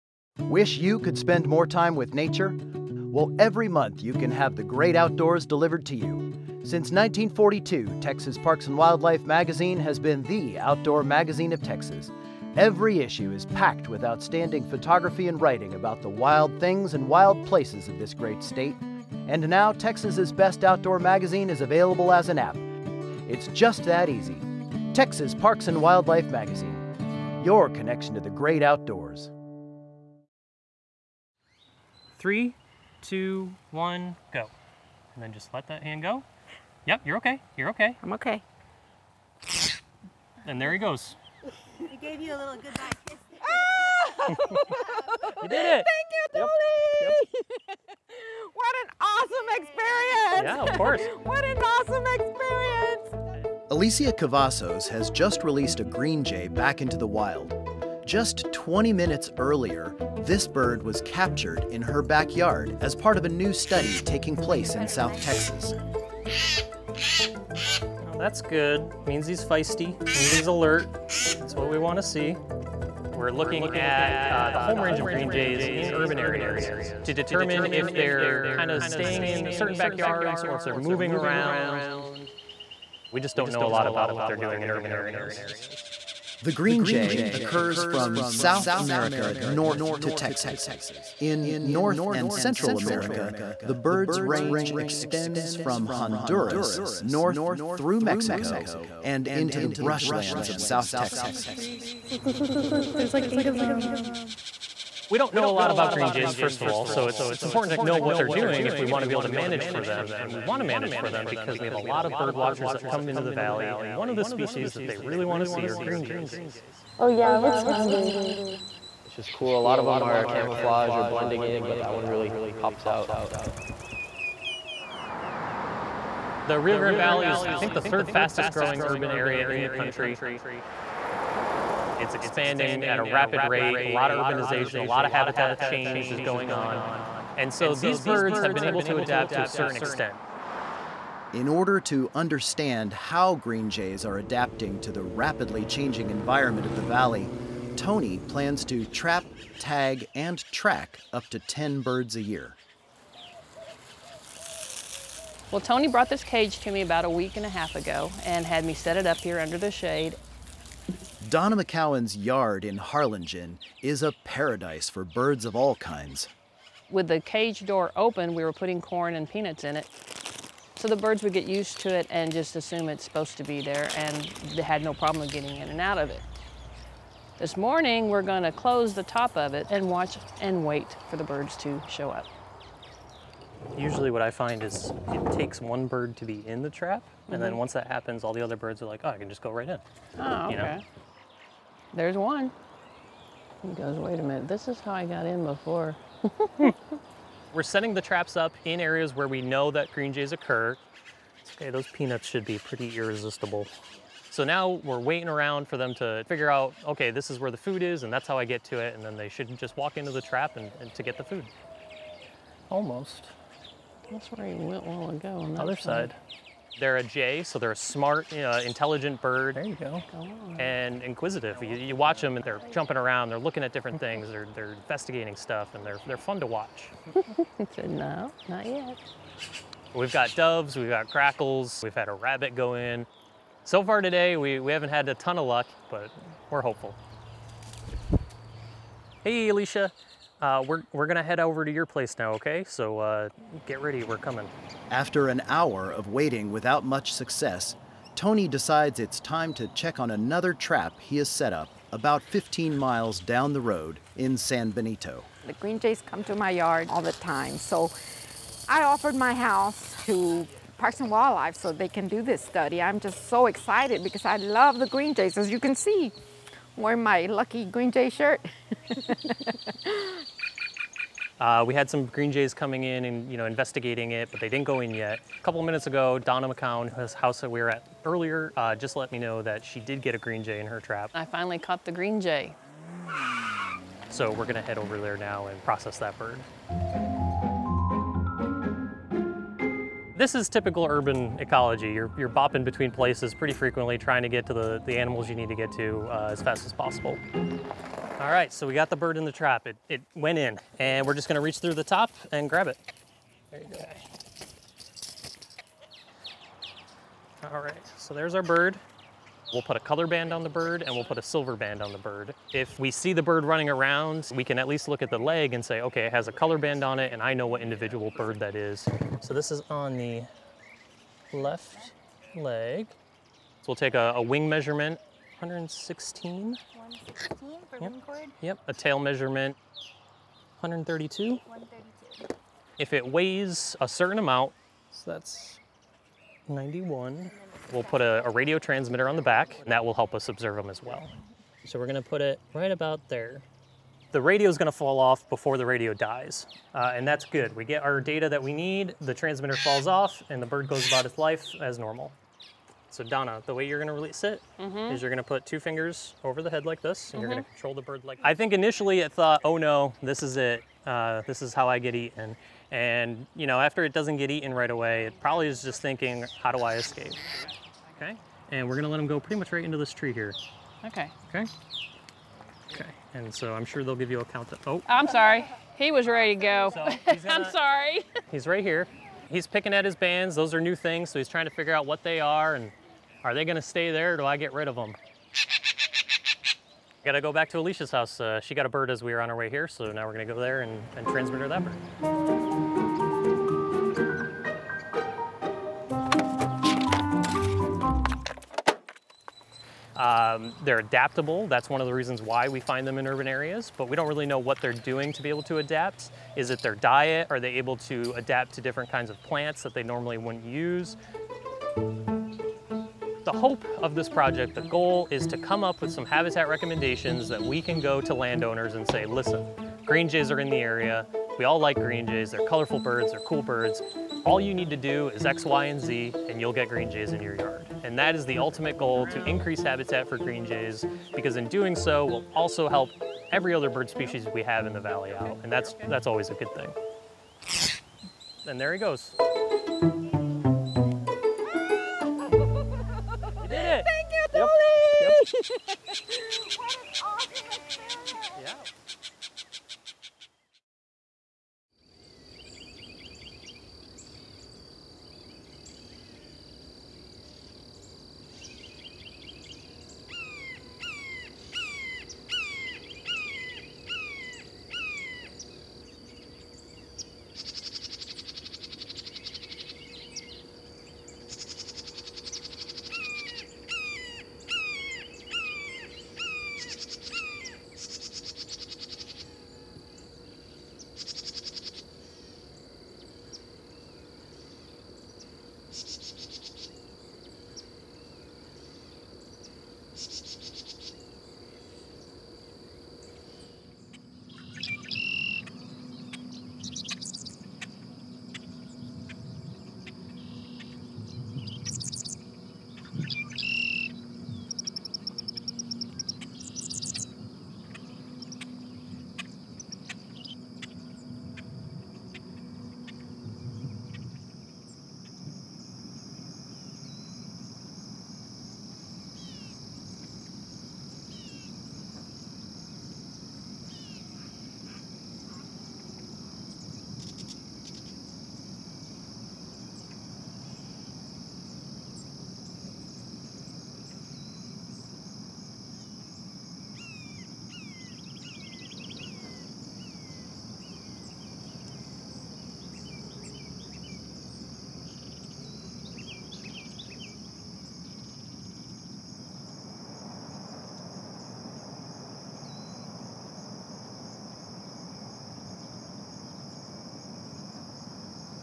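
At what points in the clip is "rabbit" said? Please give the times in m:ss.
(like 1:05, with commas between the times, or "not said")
3:52.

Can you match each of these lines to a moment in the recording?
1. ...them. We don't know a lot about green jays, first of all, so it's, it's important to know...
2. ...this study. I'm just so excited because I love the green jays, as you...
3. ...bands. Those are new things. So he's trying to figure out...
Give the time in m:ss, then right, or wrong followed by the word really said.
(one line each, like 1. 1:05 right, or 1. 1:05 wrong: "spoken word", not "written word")
1. 1:43 right
2. 4:22 right
3. 6:19 right.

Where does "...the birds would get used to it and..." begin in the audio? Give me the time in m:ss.
2:50.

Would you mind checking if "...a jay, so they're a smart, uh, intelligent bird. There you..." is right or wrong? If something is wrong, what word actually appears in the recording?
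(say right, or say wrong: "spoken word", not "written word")
right.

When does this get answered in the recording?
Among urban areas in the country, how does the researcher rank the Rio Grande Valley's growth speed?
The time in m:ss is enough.
2:07.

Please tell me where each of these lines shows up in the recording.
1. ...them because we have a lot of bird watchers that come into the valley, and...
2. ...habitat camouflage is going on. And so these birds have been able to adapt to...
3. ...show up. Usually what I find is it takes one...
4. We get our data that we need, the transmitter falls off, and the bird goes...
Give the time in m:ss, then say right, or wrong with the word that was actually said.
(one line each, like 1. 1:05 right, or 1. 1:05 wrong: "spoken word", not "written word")
1. 1:51 right
2. 2:15 wrong: "change", not "camouflage"
3. 3:01 right
4. 5:47 right.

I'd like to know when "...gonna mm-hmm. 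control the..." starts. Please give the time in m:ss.
5:57.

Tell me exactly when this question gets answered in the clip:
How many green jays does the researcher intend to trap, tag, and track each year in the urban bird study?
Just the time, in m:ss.
2:31.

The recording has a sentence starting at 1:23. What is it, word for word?
We just don't know a lot about what they're doing in urban areas.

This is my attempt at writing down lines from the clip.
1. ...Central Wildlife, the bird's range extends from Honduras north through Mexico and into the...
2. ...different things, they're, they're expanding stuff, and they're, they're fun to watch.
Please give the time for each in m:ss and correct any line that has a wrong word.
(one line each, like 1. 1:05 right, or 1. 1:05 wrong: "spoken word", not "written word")
1. 1:32 wrong: "America", not "Wildlife"
2. 3:43 wrong: "investigating", not "expanding".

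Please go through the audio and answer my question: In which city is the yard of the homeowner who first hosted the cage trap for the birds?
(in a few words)
Harlingen.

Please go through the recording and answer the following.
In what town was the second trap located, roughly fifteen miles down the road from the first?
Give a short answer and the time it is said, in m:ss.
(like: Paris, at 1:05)
San Benito, at 4:14.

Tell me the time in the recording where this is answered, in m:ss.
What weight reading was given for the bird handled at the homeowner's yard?
5:36.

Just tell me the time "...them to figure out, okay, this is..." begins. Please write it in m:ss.
3:25.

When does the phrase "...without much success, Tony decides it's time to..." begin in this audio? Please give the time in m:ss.
4:06.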